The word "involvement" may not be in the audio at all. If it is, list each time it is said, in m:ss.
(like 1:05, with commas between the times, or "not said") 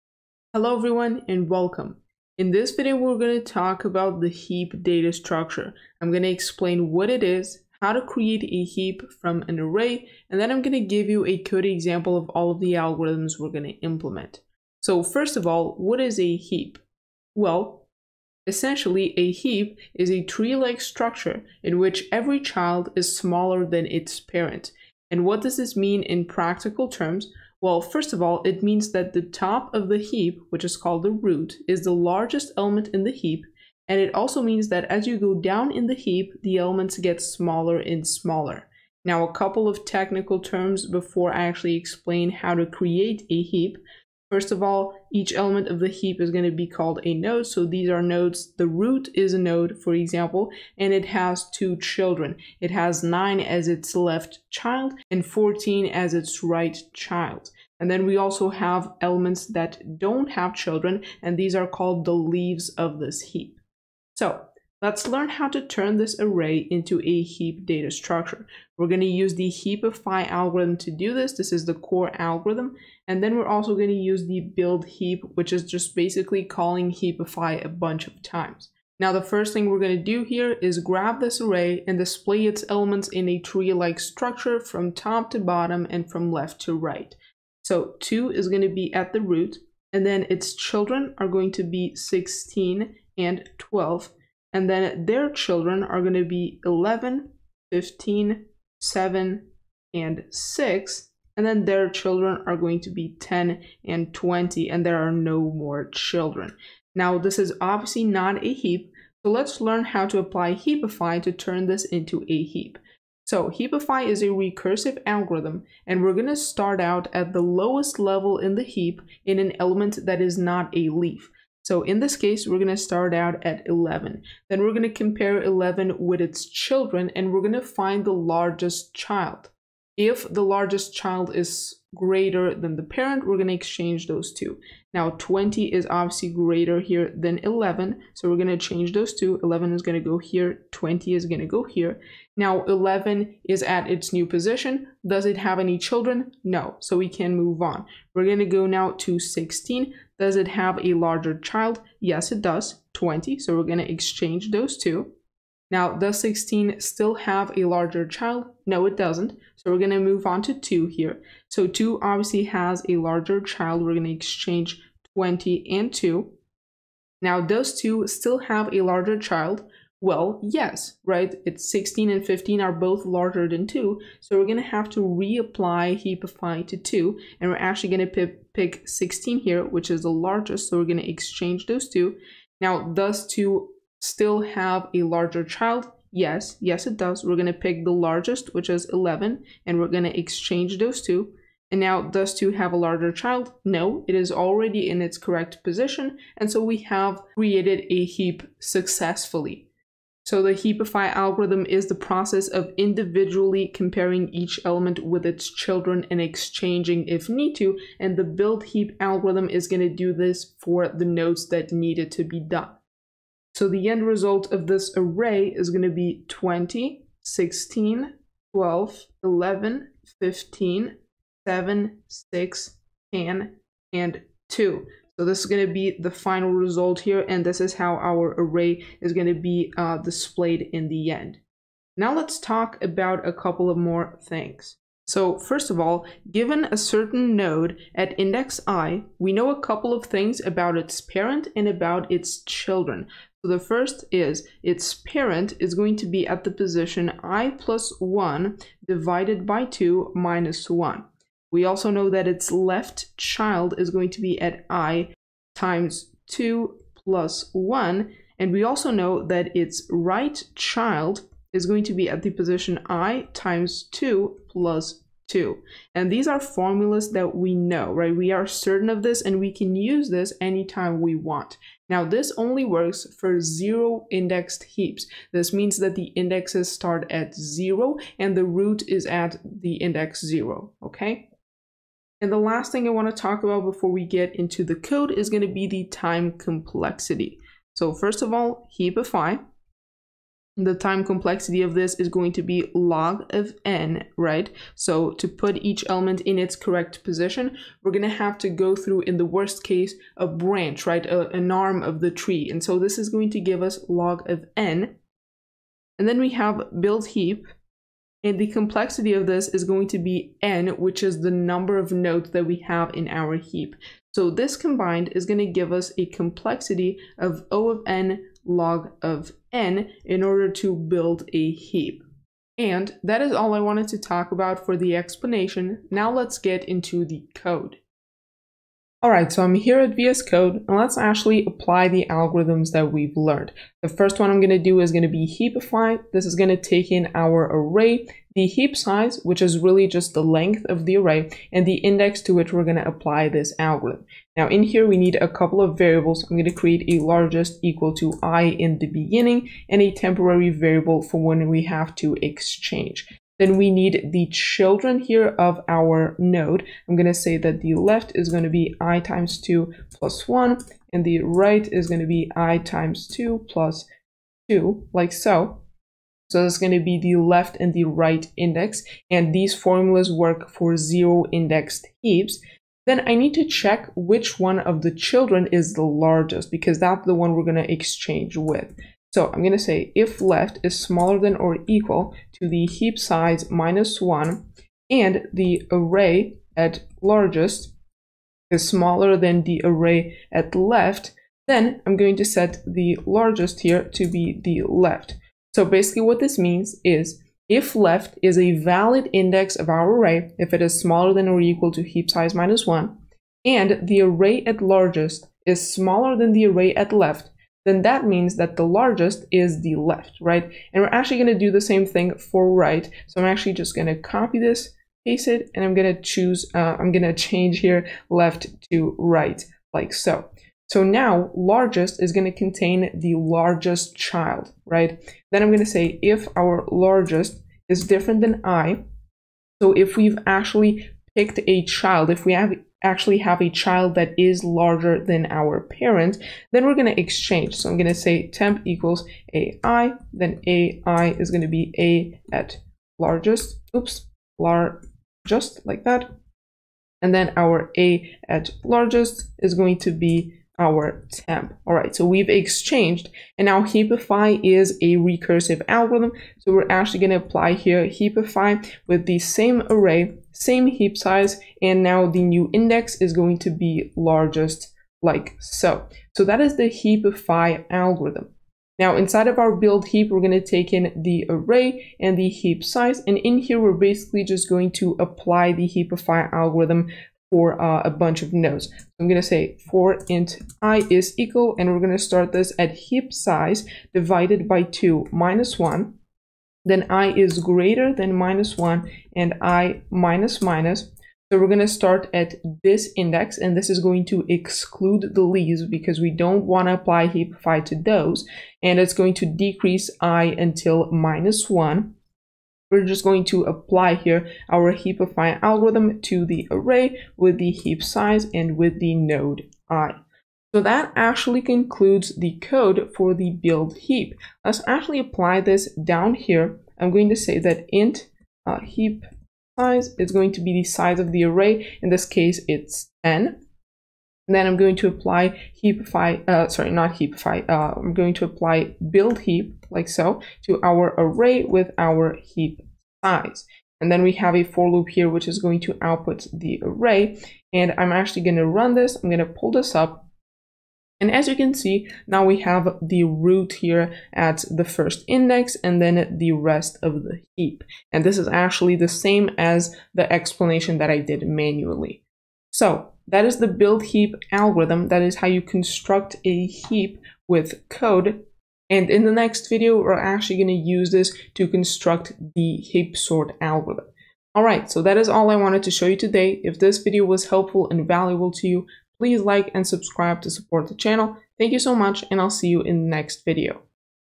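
not said.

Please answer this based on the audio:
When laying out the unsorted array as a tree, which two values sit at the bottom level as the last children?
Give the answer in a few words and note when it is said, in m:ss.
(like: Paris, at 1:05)
10 and 20, at 1:43.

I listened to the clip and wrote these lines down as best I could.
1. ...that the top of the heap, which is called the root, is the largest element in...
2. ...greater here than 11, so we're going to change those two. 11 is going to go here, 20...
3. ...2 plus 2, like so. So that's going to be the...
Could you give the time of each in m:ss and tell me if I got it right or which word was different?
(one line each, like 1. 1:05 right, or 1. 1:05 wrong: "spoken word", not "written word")
1. 0:28 right
2. 2:16 right
3. 6:03 right.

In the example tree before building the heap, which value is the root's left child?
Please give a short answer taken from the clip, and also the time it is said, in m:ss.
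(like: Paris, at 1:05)
9, at 0:53.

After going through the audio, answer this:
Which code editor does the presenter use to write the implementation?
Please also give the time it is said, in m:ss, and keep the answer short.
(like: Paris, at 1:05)
VS Code, at 5:29.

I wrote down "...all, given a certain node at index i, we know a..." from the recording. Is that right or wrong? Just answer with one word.
right.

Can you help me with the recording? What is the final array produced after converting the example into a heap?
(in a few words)
20, 16, 12, 11, 15, 7, 6, 10, 2.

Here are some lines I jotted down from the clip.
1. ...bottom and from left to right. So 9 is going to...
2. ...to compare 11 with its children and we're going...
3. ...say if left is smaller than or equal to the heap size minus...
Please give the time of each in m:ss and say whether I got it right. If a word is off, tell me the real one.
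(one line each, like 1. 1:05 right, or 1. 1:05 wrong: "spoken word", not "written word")
1. 1:25 wrong: "2", not "9"
2. 2:04 right
3. 6:19 right.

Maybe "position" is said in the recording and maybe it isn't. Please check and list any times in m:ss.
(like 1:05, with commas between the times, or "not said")
2:24, 3:15, 4:06, 4:22, 4:57.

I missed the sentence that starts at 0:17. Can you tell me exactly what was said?
Well, essentially a heap is a tree-like structure in which every child is smaller than its parent.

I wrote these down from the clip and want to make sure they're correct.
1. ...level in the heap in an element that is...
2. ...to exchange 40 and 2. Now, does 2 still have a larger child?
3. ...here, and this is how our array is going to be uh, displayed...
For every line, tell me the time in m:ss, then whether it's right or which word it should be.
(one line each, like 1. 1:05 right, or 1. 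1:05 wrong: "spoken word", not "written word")
1. 1:57 right
2. 2:44 wrong: "20", not "40"
3. 3:47 right.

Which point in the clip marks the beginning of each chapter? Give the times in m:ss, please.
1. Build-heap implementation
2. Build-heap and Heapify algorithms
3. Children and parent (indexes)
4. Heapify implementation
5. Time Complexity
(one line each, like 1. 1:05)
1. 7:48
2. 1:04
3. 3:54
4. 5:28
5. 4:41.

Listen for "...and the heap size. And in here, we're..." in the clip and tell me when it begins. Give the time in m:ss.
7:51.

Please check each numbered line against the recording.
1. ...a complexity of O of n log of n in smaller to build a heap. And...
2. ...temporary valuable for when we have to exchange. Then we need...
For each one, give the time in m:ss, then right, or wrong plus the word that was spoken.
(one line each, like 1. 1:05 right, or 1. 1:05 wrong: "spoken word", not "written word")
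1. 5:15 wrong: "order", not "smaller"
2. 5:49 wrong: "variable", not "valuable".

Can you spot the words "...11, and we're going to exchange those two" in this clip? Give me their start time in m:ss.
3:08.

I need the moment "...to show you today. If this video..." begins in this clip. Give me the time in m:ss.
9:25.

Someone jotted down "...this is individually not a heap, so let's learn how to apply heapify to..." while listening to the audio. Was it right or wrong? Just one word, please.
wrong.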